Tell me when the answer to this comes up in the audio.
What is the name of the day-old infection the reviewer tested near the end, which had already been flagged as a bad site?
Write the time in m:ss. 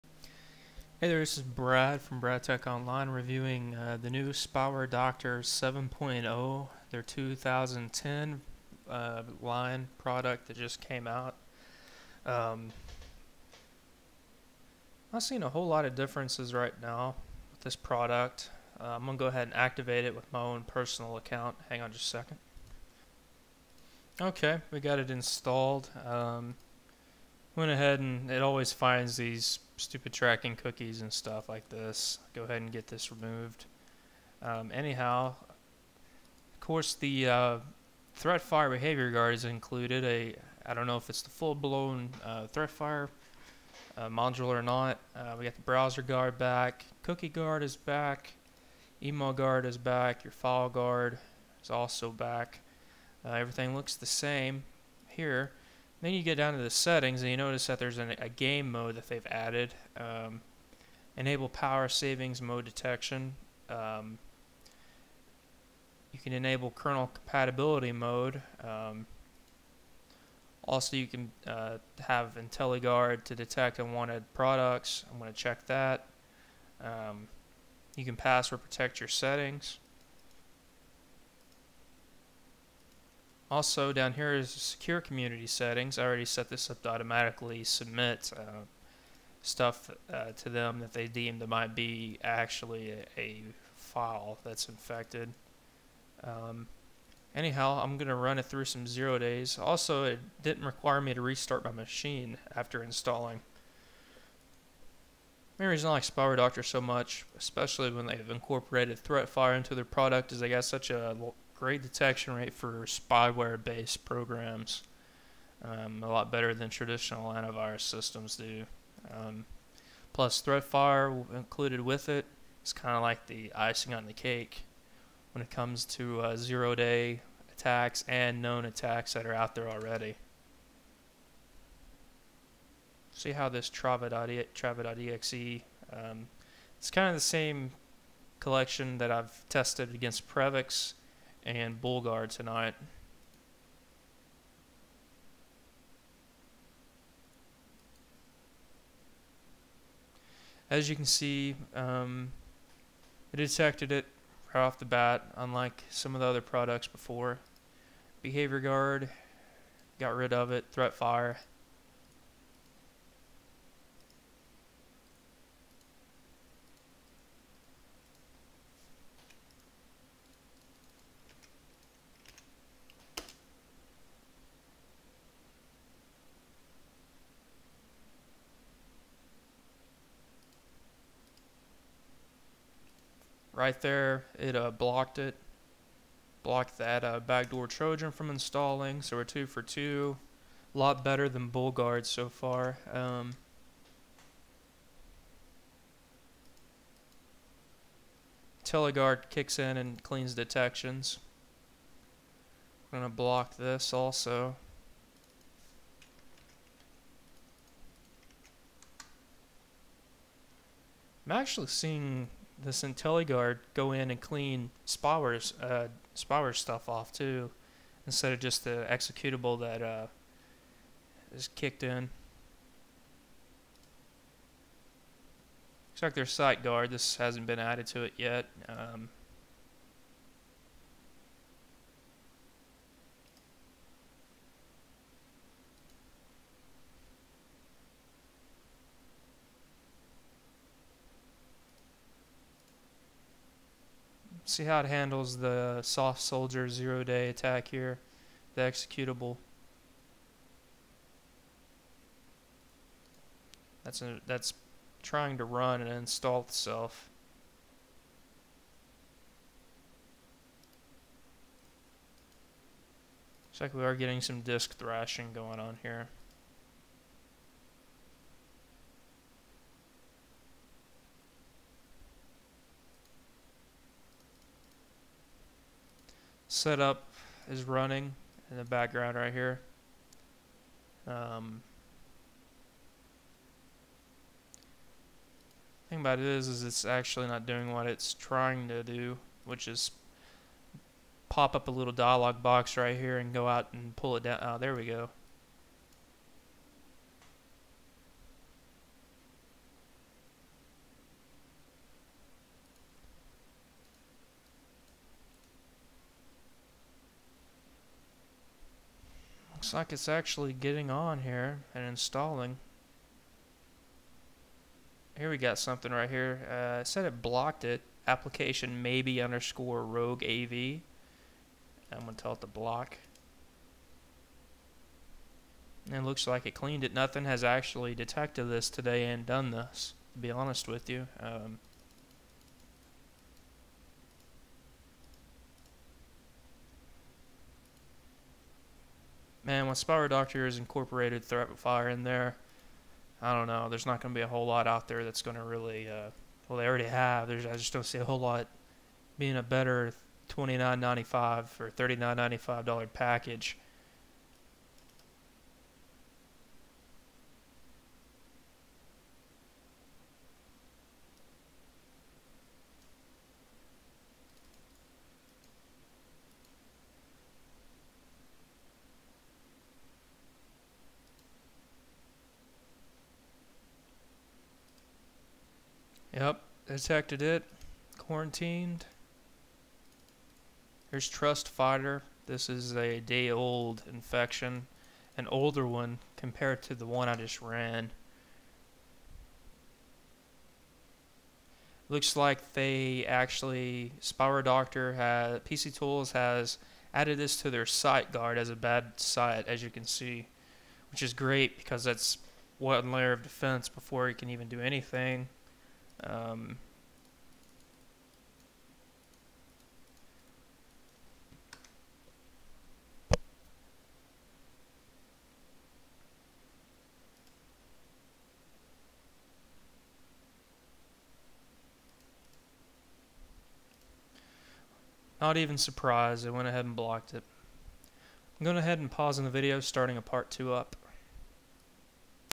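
6:21.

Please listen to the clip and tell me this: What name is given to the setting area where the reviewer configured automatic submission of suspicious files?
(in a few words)
secure community settings.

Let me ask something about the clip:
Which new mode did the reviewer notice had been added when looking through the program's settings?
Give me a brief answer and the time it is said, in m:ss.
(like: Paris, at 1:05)
game mode, at 0:58.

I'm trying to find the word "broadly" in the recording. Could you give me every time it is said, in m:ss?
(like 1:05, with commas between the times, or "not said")
not said.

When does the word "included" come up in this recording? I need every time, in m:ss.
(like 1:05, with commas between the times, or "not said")
0:39, 2:01.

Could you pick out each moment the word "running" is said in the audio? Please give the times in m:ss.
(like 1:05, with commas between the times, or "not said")
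4:37.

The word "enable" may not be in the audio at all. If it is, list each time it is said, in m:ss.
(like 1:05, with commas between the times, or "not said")
1:01, 1:06.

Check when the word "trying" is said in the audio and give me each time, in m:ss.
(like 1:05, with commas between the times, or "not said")
4:15, 4:48.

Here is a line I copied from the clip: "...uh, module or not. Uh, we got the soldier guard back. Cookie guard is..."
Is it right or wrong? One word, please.
wrong.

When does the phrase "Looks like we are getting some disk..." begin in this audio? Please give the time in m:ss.
4:23.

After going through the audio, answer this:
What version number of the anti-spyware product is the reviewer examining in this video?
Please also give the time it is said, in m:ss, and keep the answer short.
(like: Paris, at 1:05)
7.0, at 0:05.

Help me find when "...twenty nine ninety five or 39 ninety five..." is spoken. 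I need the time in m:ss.
5:50.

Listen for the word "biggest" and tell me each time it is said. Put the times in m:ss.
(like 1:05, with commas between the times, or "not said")
not said.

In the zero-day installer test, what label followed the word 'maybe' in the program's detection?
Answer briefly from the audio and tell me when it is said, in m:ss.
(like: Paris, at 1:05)
rogue AV, at 5:19.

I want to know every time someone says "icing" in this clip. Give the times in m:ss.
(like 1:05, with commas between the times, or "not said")
2:03.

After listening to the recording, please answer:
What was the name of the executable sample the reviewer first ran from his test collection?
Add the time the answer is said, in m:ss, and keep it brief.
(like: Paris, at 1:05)
Trava.exe, at 2:13.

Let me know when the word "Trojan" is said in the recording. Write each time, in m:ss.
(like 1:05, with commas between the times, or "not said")
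3:07.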